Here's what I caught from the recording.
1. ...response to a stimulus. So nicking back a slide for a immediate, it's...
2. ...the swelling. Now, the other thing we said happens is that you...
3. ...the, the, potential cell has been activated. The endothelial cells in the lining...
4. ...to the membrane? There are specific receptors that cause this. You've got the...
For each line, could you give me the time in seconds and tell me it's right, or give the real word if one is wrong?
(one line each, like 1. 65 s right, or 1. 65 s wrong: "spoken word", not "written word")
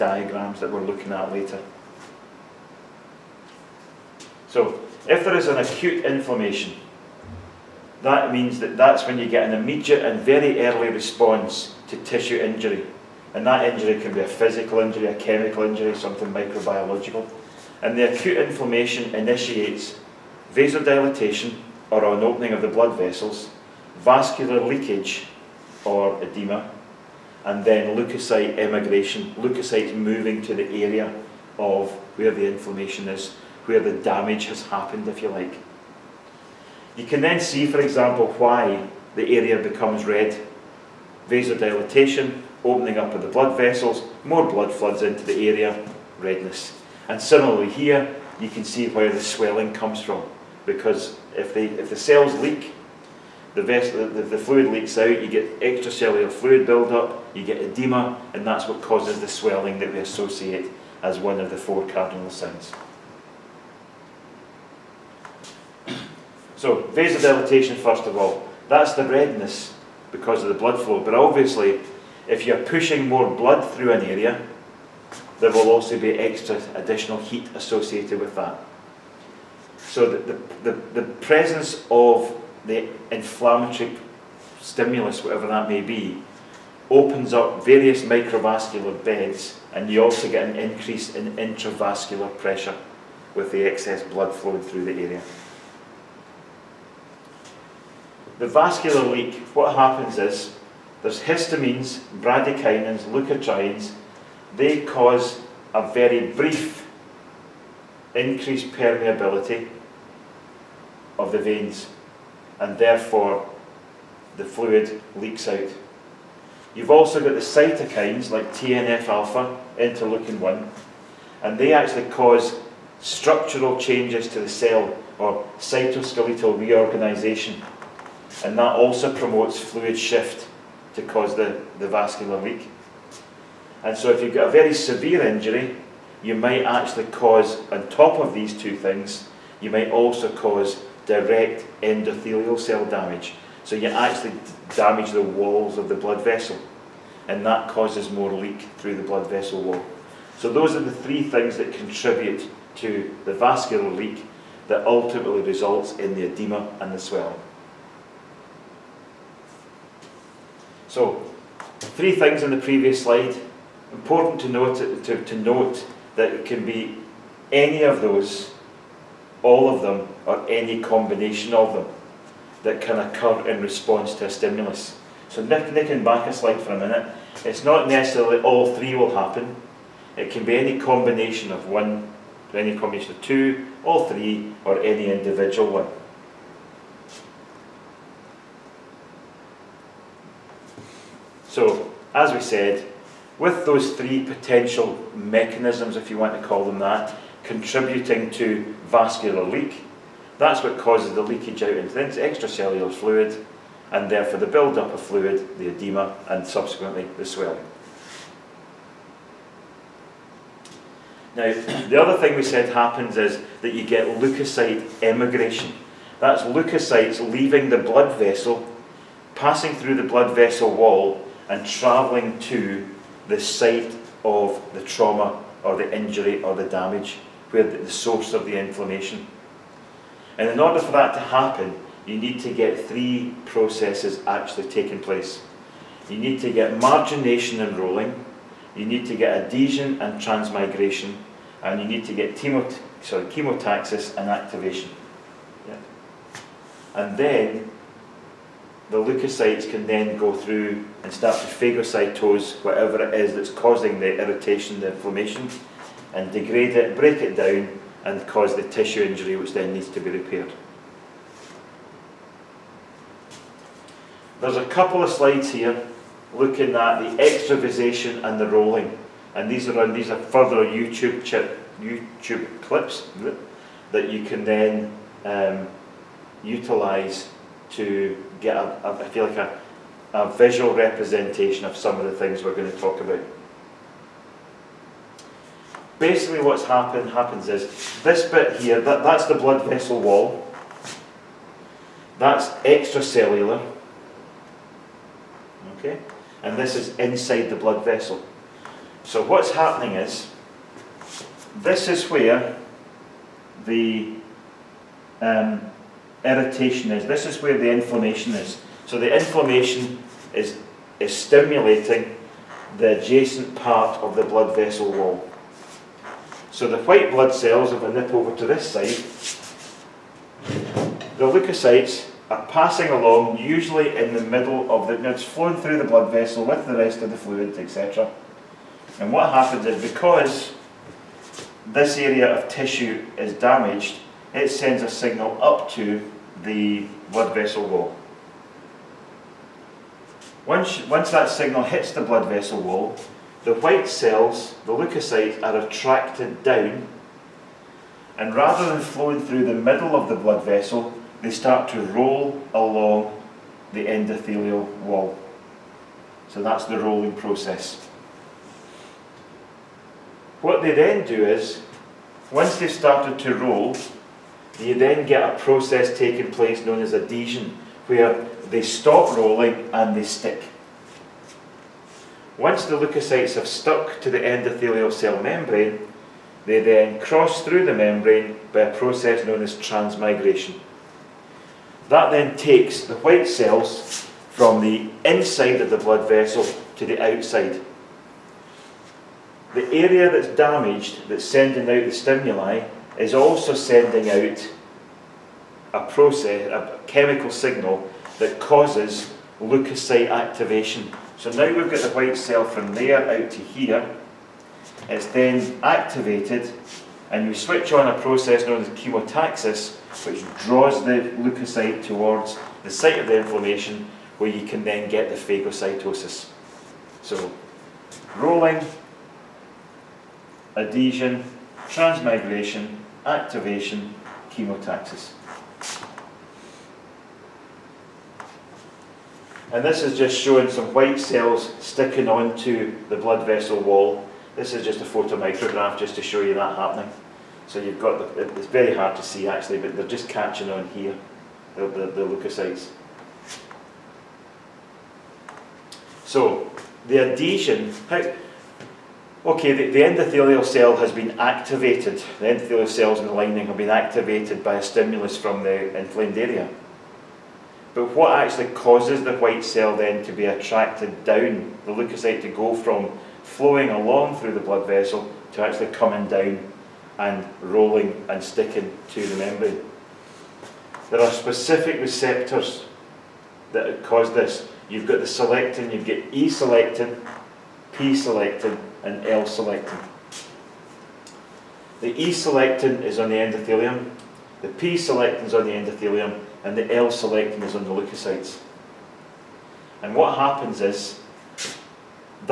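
1. 173 s wrong: "minute", not "immediate"
2. 207 s right
3. 449 s wrong: "endothelial", not "potential"
4. 468 s right.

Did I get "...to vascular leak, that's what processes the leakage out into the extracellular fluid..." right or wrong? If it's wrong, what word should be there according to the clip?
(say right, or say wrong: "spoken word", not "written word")
wrong: "causes", not "processes".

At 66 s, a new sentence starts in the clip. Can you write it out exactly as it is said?
So vasodilatation first of all, that's the redness because of the blood flow.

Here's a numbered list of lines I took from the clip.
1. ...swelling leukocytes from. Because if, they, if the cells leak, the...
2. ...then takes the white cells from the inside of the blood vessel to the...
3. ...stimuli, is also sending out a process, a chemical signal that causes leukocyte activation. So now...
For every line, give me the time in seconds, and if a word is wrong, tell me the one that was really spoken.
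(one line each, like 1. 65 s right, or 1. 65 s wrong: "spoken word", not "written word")
1. 49 s wrong: "comes", not "leukocytes"
2. 382 s right
3. 391 s right.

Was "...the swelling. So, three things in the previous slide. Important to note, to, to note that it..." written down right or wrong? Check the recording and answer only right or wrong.
right.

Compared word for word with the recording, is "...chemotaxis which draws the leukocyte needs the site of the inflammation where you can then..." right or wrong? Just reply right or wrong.
wrong.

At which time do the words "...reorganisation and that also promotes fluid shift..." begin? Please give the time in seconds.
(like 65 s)
126 s.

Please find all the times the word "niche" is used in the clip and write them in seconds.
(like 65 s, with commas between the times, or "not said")
not said.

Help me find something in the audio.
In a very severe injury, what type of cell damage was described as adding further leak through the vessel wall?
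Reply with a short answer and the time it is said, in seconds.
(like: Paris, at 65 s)
Direct endothelial cell damage, at 141 s.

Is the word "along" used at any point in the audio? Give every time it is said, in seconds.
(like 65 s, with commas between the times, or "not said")
322 s, 352 s, 463 s.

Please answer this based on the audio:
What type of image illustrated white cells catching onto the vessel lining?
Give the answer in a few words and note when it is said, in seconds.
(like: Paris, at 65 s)
Photomicrograph, at 434 s.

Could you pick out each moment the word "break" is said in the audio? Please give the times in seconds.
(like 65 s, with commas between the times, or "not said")
256 s.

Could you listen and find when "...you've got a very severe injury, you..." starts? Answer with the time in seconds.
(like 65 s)
134 s.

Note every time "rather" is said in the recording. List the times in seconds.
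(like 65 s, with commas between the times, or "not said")
348 s.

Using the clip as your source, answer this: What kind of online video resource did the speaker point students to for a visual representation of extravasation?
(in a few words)
YouTube clips.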